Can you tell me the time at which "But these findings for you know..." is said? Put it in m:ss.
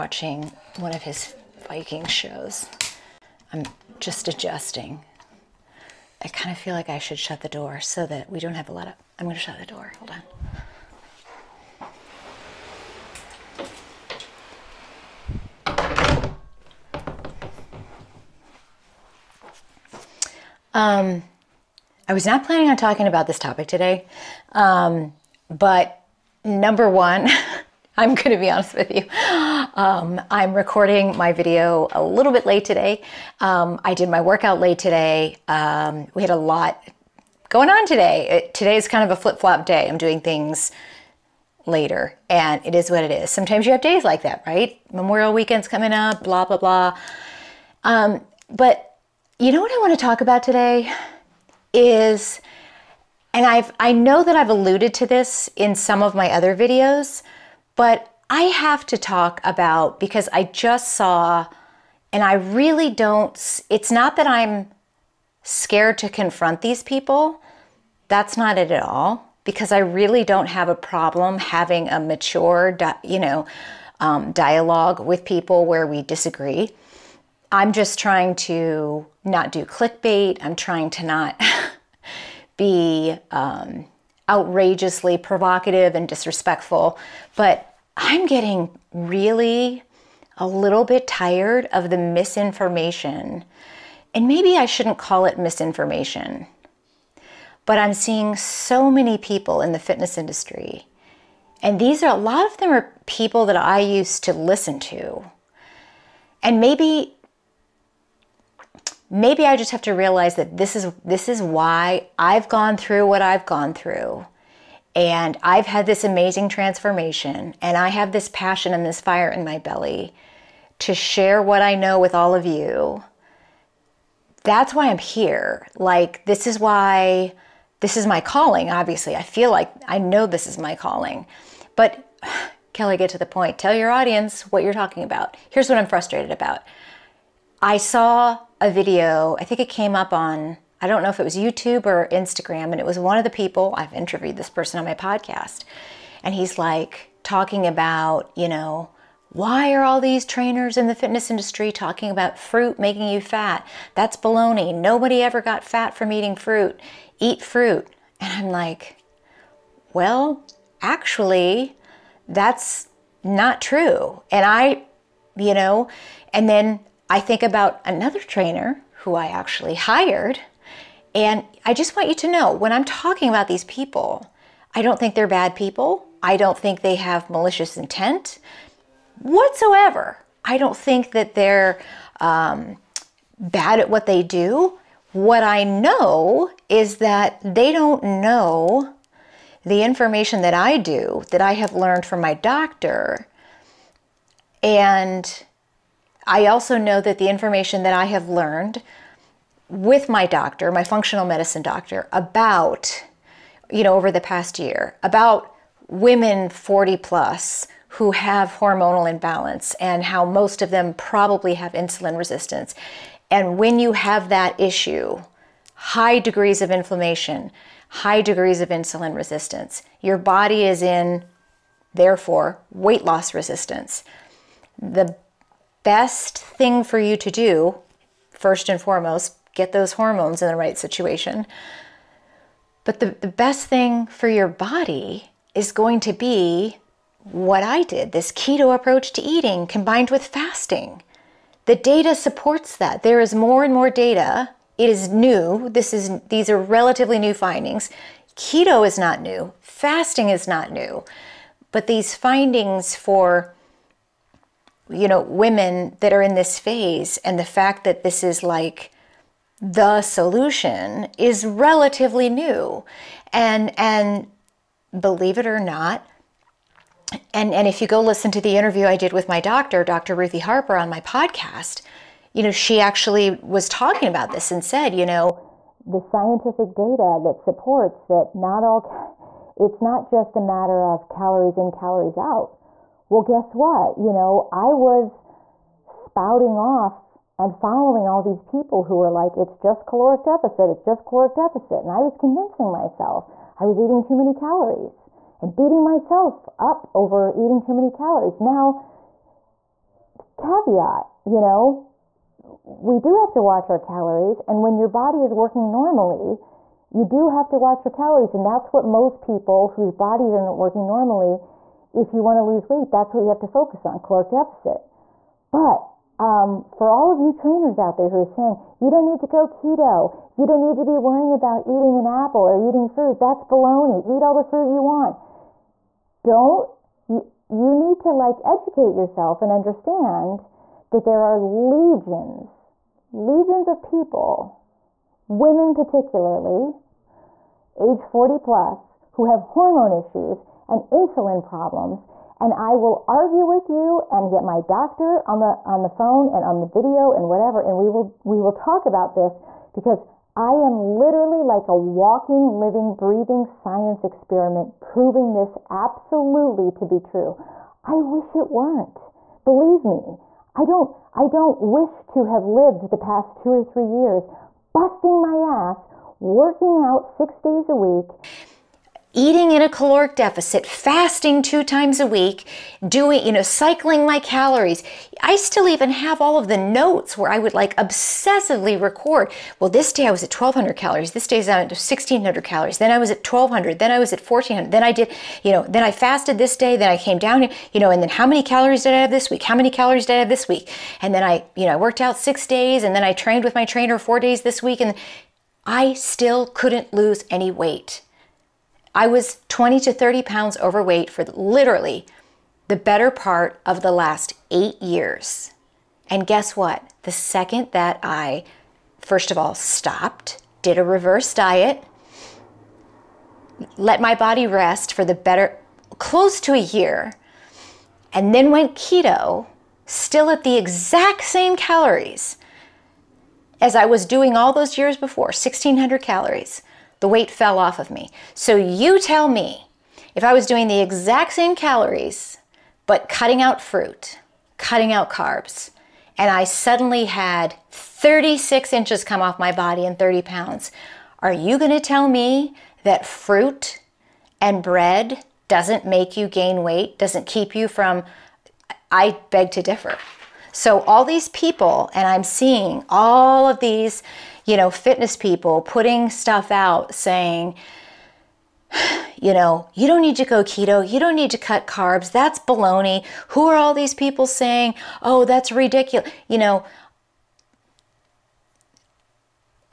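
4:11.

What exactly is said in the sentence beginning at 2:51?
And I just want you to know when I'm talking about these people, I don't think they're bad people.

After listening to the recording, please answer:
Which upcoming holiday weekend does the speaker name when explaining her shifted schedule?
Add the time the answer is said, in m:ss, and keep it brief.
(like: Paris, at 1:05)
Memorial weekend, at 0:44.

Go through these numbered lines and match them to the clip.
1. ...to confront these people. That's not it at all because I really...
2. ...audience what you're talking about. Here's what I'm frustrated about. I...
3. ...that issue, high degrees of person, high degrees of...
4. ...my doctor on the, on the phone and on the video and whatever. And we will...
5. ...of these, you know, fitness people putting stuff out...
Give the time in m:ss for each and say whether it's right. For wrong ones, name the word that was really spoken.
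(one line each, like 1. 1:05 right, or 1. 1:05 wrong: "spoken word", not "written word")
1. 1:05 right
2. 2:13 right
3. 3:34 wrong: "inflammation", not "person"
4. 5:44 right
5. 7:33 right.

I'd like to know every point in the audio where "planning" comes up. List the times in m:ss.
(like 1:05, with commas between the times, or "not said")
0:22.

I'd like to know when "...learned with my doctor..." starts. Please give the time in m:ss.
3:18.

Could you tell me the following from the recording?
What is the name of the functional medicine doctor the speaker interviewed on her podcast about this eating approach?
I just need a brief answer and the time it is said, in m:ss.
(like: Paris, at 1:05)
Dr. Ruthie Harper, at 4:29.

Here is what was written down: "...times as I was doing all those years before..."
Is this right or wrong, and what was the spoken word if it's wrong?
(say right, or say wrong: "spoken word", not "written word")
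wrong: "calories", not "times".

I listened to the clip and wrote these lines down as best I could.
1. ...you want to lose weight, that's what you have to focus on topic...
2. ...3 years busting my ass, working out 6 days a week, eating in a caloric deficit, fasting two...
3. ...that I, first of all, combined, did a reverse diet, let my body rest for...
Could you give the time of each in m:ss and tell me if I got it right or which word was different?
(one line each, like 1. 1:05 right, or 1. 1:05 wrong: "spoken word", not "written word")
1. 5:12 wrong: "caloric", not "topic"
2. 6:03 right
3. 6:47 wrong: "stopped", not "combined".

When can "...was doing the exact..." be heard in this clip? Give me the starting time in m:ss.
7:10.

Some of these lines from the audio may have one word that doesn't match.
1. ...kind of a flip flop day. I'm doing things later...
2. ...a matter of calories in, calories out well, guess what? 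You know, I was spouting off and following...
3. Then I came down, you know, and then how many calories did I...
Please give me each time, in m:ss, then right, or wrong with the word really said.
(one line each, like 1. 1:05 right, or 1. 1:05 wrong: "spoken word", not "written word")
1. 0:38 right
2. 4:40 right
3. 6:26 right.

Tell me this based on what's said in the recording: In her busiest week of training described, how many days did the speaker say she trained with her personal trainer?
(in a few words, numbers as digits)
4 days.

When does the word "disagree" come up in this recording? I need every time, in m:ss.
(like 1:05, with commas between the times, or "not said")
1:16.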